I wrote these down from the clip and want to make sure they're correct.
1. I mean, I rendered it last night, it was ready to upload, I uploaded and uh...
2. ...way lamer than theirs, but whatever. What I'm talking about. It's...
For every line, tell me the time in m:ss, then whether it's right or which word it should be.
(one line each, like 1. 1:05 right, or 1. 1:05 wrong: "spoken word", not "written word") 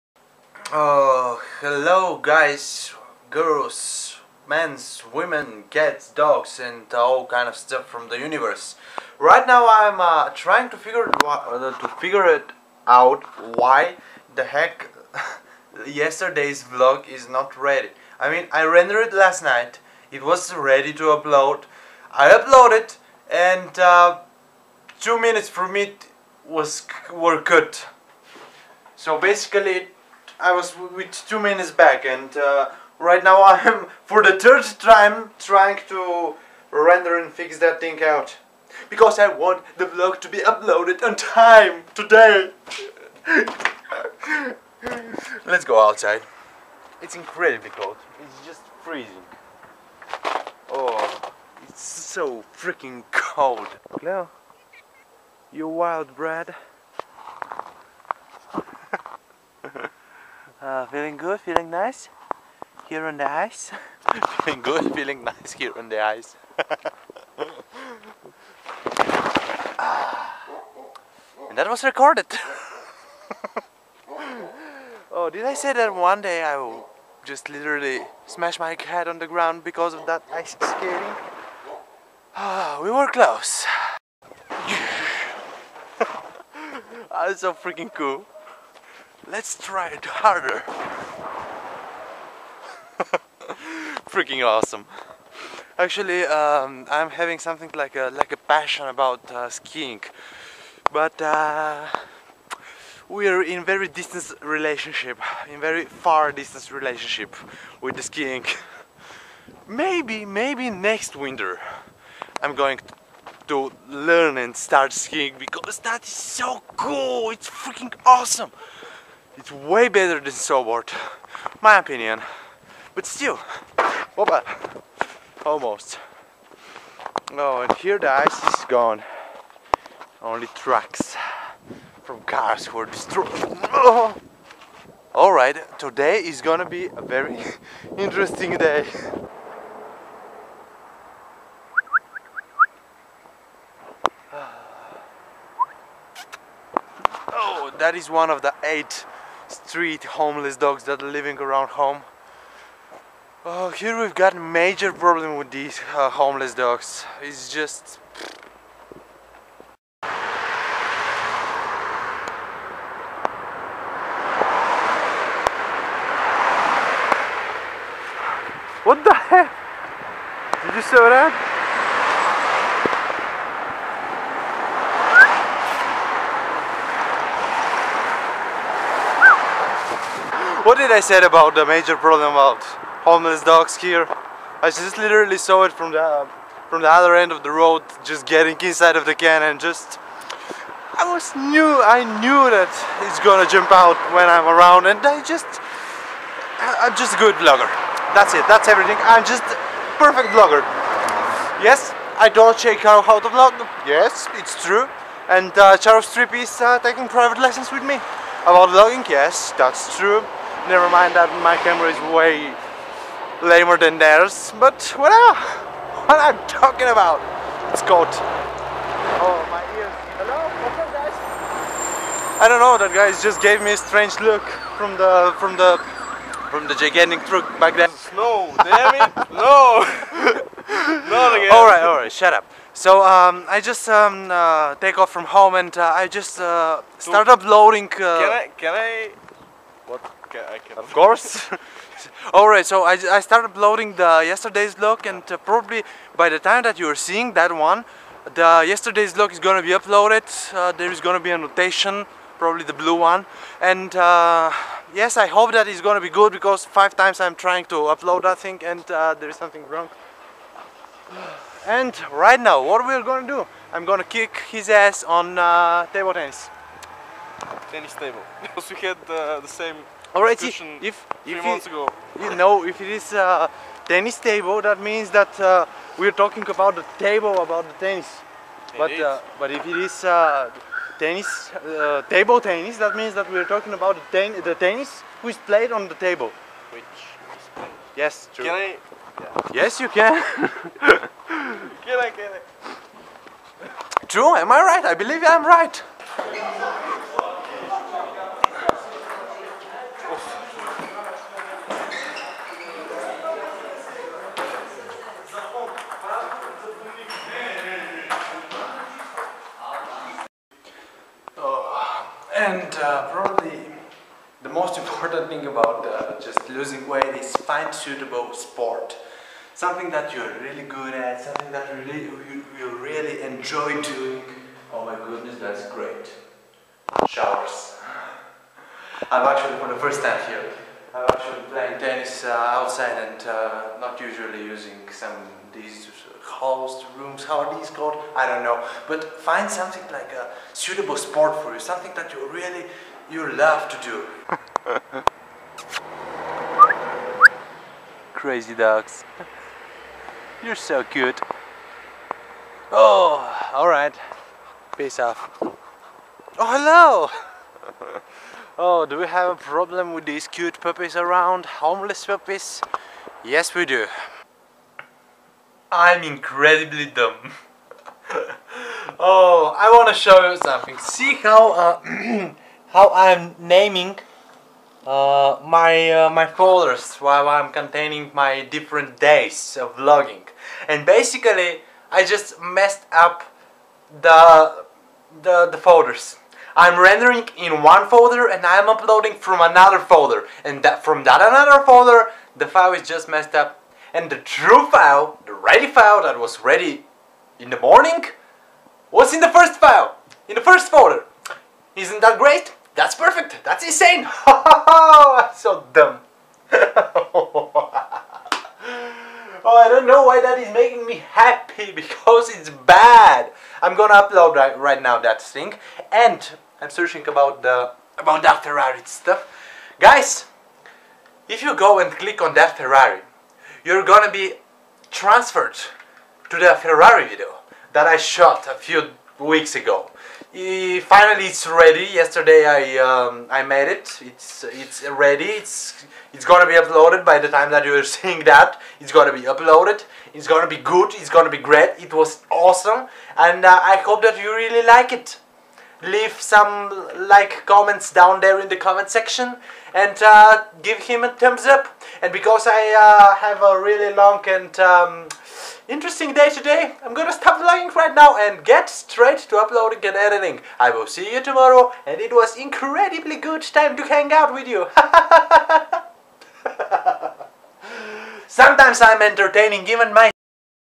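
1. 0:18 right
2. 3:32 right.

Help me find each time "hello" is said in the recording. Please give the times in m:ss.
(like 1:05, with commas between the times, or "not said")
0:01, 3:40, 5:57.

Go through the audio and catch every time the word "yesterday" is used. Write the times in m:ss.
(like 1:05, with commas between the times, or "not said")
0:15, 4:04, 4:08, 7:12.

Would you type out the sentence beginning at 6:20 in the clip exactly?
And basically, I just messed up the the, the folders.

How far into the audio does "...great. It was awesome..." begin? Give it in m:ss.
7:21.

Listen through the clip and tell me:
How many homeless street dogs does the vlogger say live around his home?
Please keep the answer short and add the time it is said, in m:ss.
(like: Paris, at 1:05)
8, at 2:28.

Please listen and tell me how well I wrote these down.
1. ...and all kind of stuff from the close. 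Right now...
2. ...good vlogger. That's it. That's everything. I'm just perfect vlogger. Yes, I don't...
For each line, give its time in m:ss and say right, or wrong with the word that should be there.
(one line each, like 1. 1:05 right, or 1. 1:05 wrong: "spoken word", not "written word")
1. 0:06 wrong: "universe", not "close"
2. 3:17 right.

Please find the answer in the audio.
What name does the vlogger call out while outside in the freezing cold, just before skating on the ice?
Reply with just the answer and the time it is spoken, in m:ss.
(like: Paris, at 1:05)
Leo, at 0:54.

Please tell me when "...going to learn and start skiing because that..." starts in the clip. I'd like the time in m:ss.
1:52.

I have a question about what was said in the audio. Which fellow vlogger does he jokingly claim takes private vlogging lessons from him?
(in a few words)
Charles Tripp.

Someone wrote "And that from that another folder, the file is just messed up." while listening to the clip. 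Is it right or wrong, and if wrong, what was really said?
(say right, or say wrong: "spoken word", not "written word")
right.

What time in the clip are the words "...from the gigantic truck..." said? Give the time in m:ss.
3:46.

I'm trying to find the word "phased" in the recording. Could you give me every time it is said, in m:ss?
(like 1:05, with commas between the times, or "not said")
not said.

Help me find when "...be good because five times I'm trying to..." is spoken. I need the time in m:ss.
4:16.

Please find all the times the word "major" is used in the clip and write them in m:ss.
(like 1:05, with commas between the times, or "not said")
2:34, 3:01.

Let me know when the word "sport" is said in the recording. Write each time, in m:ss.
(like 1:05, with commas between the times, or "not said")
5:18, 5:40.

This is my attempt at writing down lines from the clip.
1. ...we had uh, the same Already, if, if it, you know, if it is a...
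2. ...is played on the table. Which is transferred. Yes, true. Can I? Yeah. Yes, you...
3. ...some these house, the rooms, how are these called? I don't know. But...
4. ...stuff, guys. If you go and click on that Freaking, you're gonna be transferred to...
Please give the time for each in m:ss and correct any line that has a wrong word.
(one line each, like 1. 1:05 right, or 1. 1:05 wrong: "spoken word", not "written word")
1. 4:28 right
2. 4:45 wrong: "played", not "transferred"
3. 5:34 right
4. 6:58 wrong: "Ferrari", not "Freaking".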